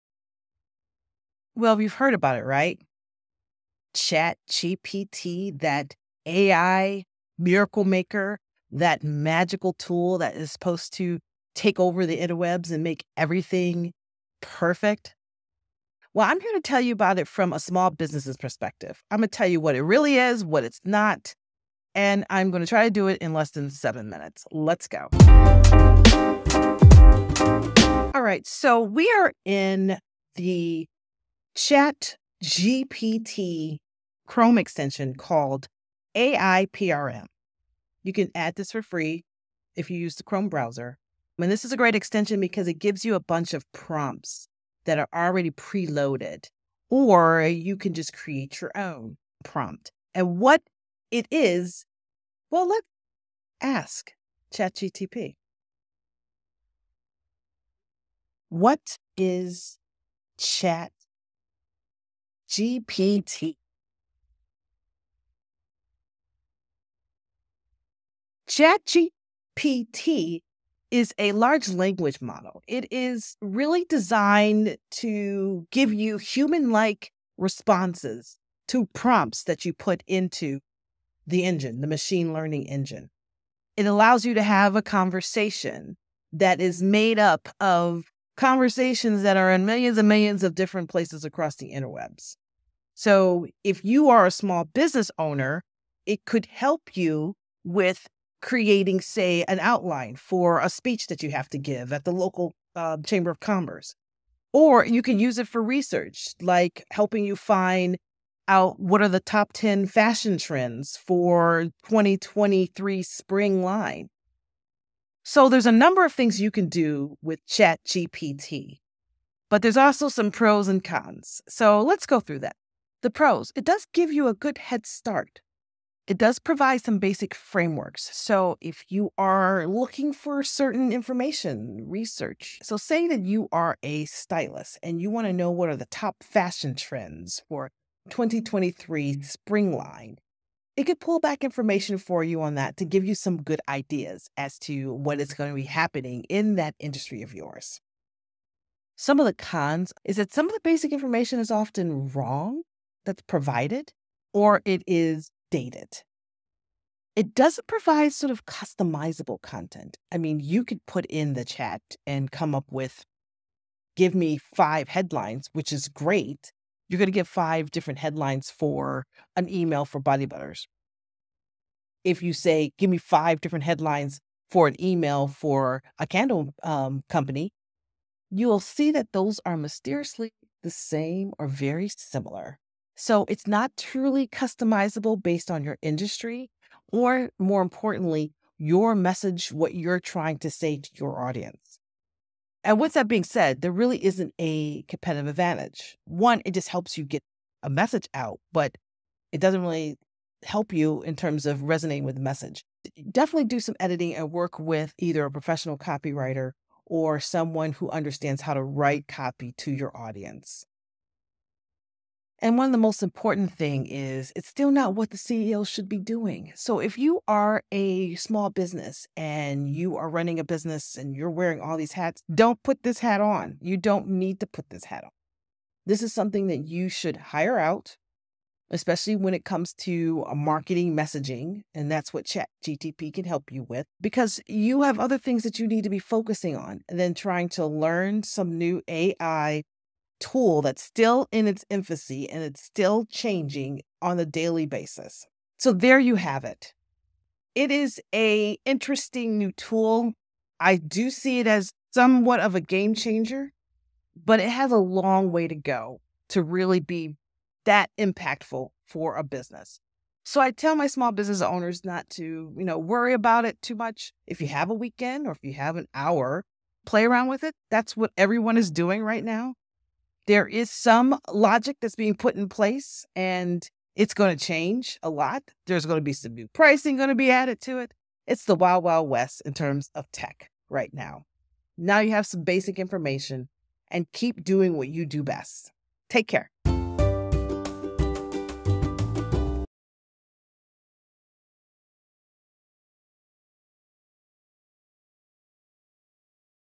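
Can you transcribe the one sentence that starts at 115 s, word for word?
So there's a number of things you can do with ChatGPT, but there's also some pros and cons.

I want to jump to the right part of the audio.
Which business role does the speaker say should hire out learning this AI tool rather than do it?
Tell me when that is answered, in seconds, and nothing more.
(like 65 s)
215 s.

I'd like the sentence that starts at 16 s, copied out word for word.
Well, I'm here to tell you about it from a small business's perspective.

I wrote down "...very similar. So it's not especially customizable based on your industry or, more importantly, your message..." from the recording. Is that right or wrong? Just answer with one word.
wrong.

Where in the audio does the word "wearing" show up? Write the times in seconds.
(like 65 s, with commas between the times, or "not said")
221 s.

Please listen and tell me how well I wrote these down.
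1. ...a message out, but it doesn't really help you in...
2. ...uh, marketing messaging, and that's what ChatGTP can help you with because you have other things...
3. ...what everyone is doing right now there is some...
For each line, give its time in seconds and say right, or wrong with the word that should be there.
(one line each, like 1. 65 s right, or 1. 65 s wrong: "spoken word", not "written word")
1. 197 s right
2. 230 s right
3. 267 s right.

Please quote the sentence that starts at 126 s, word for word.
It does provide some basic frameworks.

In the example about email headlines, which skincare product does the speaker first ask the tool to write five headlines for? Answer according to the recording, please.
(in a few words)
body butters.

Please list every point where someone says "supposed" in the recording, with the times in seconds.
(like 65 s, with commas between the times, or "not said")
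10 s.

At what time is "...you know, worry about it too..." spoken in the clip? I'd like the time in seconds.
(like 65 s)
262 s.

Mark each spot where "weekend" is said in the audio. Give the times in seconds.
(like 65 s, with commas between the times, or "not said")
264 s.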